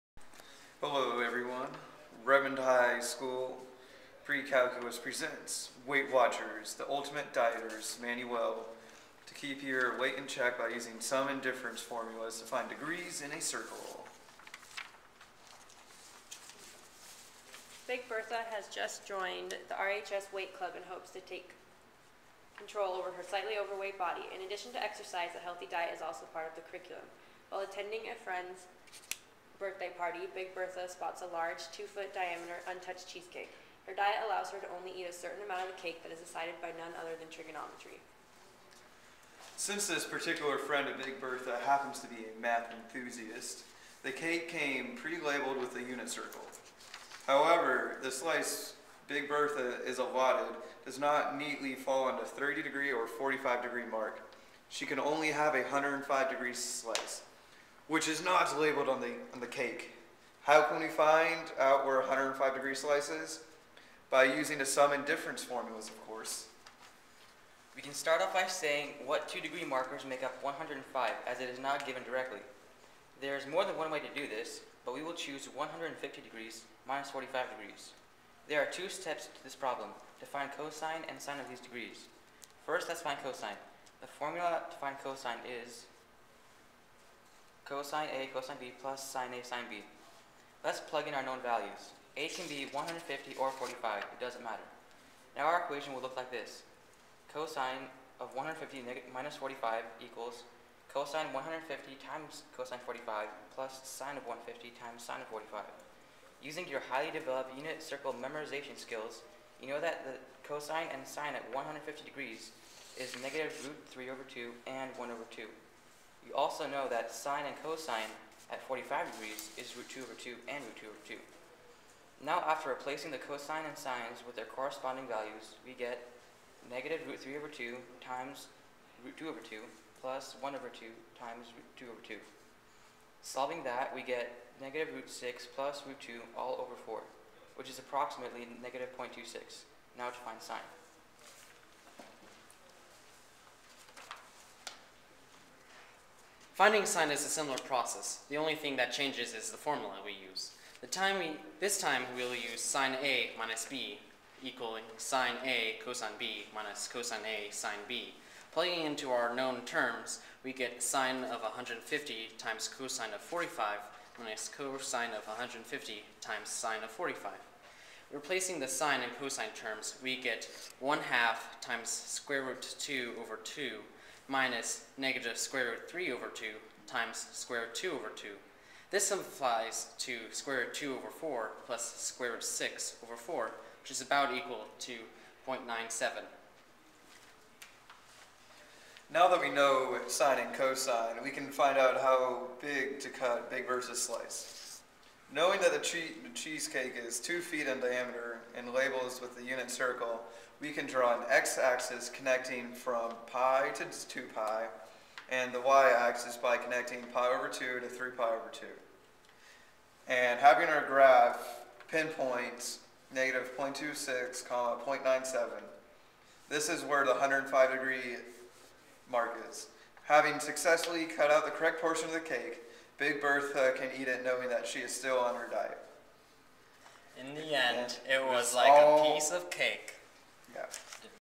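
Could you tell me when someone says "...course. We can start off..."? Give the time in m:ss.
1:06.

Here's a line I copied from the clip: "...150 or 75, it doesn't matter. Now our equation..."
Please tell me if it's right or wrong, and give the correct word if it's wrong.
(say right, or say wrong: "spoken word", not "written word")
wrong: "45", not "75".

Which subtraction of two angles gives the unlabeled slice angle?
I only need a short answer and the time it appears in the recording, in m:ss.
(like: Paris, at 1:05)
150 minus 45, at 1:15.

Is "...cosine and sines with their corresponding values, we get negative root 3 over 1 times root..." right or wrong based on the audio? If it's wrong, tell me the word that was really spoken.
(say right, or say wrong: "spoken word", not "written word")
wrong: "2", not "1".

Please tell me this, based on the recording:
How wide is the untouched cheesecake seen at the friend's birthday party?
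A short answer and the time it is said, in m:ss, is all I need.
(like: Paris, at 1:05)
2 feet, at 0:31.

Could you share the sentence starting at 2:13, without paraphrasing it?
Solving that, we get negative root 6 plus root 2 all over 4, which is approximately negative 0.26.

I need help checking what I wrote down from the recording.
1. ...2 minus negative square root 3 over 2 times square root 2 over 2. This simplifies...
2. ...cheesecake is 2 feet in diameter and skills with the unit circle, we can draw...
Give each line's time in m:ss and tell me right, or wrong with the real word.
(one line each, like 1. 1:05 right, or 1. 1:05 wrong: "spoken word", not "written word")
1. 2:53 right
2. 3:16 wrong: "labels", not "skills".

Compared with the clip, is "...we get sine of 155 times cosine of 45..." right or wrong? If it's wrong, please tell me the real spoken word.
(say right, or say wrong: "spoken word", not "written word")
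wrong: "150", not "155".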